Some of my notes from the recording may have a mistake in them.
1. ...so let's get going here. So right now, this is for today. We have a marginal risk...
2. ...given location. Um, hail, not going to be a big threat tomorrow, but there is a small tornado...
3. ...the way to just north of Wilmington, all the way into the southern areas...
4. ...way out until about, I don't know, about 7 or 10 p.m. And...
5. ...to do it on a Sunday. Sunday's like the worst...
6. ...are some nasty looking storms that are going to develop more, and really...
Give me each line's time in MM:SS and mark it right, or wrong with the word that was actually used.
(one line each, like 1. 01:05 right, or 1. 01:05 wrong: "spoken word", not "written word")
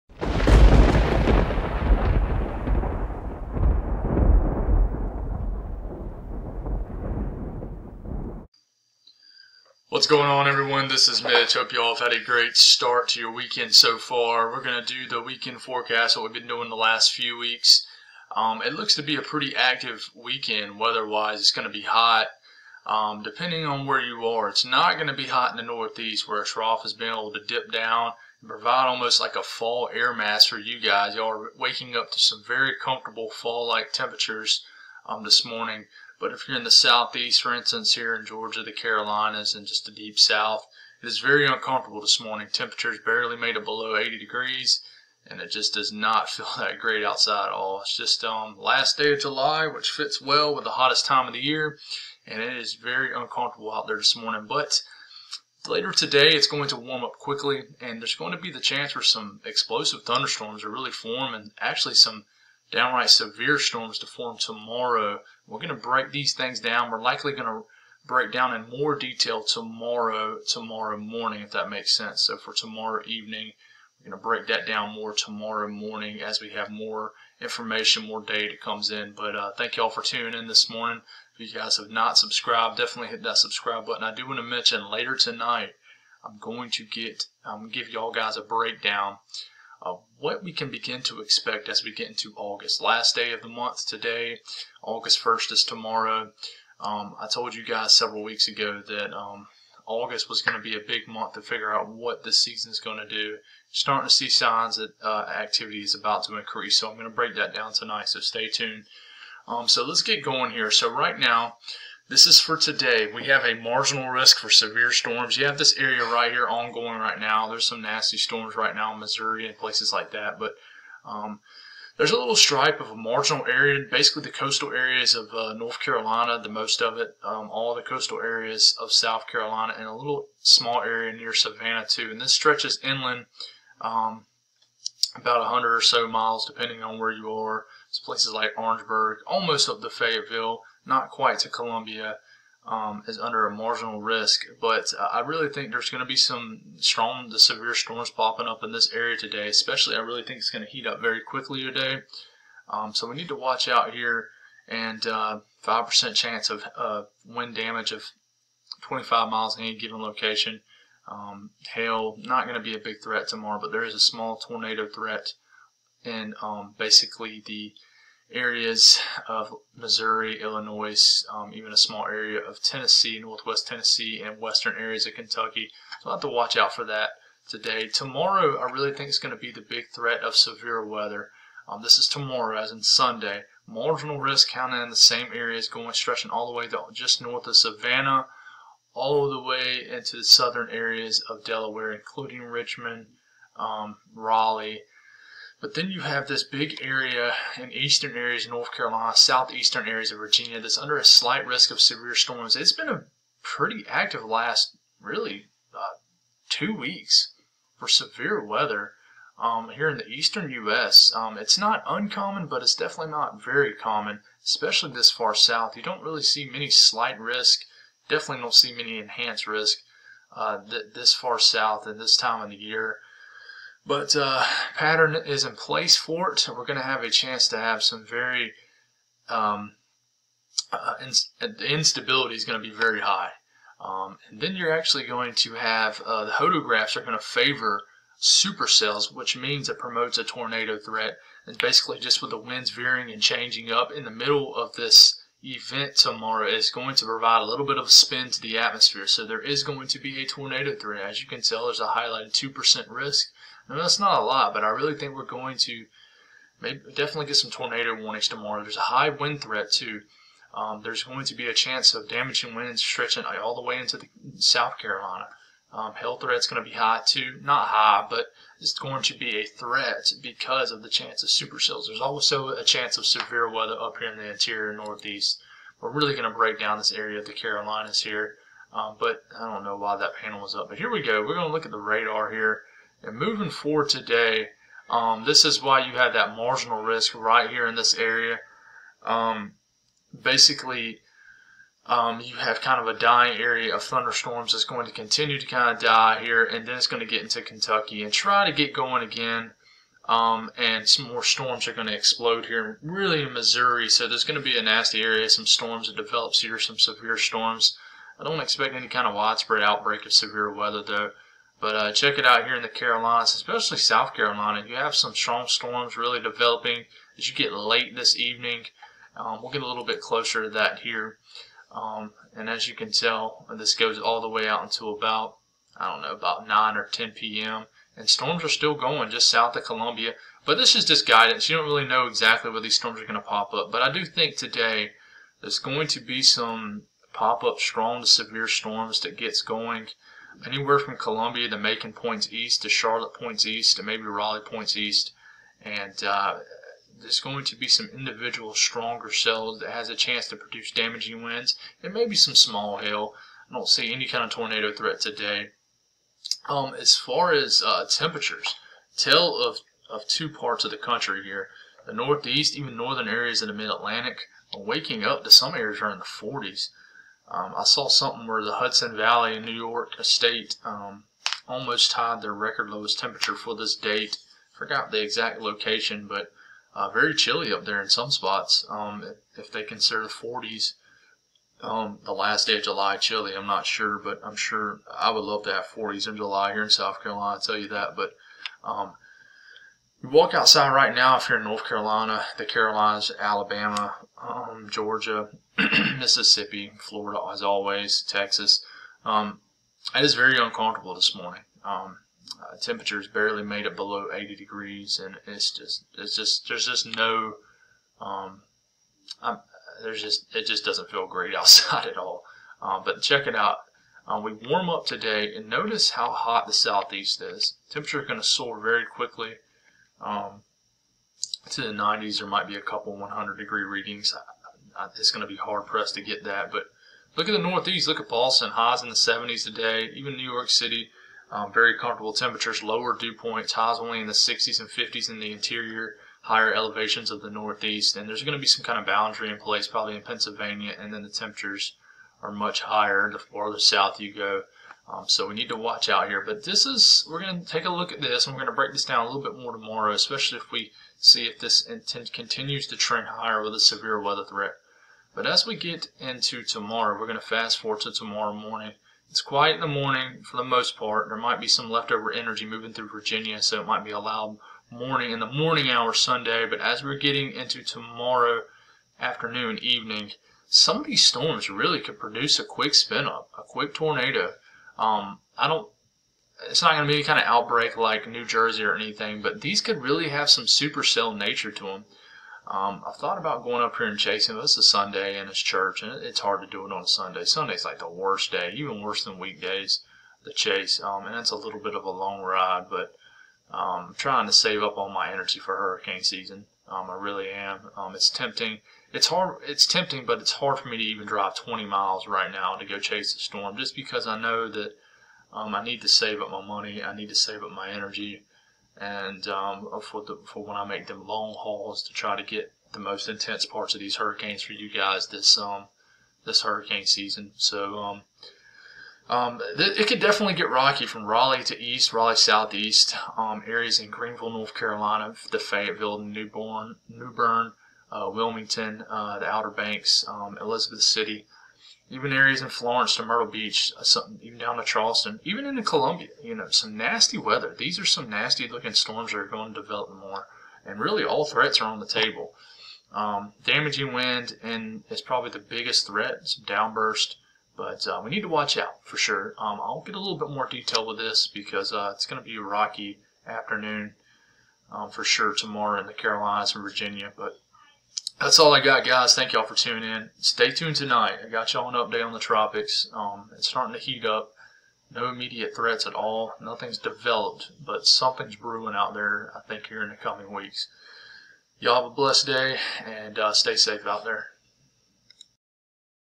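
1. 01:49 right
2. 02:39 right
3. 03:06 wrong: "Savannah", not "Wilmington"
4. 05:24 wrong: "9", not "7"
5. 08:06 right
6. 08:57 right.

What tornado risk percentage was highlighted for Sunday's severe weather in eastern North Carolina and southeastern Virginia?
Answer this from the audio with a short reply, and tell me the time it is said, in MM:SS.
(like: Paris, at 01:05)
2%, at 04:12.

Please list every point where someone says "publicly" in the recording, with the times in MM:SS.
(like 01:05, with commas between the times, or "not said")
not said.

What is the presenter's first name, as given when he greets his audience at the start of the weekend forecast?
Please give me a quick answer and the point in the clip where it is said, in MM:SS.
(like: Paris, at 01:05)
Mitch, at 00:11.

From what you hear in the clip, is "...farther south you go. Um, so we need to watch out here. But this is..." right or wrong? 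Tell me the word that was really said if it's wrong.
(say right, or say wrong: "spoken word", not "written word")
right.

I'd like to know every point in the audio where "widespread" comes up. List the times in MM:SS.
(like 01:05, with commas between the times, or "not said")
05:09.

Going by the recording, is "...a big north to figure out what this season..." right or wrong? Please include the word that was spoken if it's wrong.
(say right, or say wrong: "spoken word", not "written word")
wrong: "month", not "north".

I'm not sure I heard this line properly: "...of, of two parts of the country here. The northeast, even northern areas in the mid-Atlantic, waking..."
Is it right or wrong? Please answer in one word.
right.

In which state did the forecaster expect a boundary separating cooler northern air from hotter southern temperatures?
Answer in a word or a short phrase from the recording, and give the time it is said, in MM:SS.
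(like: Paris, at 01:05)
Pennsylvania, at 07:20.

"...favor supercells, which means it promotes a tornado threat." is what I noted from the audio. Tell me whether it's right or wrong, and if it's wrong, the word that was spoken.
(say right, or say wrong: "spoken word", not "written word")
right.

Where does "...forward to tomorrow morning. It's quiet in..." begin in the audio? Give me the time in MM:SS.
07:37.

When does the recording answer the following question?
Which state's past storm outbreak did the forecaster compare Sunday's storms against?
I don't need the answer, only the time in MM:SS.
07:58.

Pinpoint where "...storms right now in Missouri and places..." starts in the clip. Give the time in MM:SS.
01:58.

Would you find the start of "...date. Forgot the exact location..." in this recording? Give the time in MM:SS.
06:13.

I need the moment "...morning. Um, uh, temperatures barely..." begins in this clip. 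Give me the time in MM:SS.
06:41.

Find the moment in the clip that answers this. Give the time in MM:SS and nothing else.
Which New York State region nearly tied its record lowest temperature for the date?
06:08.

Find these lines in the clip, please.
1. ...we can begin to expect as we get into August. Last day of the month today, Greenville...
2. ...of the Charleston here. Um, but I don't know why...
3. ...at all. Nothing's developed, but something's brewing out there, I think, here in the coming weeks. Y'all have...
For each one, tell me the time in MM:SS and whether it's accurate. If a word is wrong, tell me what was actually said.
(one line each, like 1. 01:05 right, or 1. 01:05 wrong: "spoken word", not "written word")
1. 01:30 wrong: "August", not "Greenville"
2. 04:37 wrong: "Carolinas", not "Charleston"
3. 09:25 right.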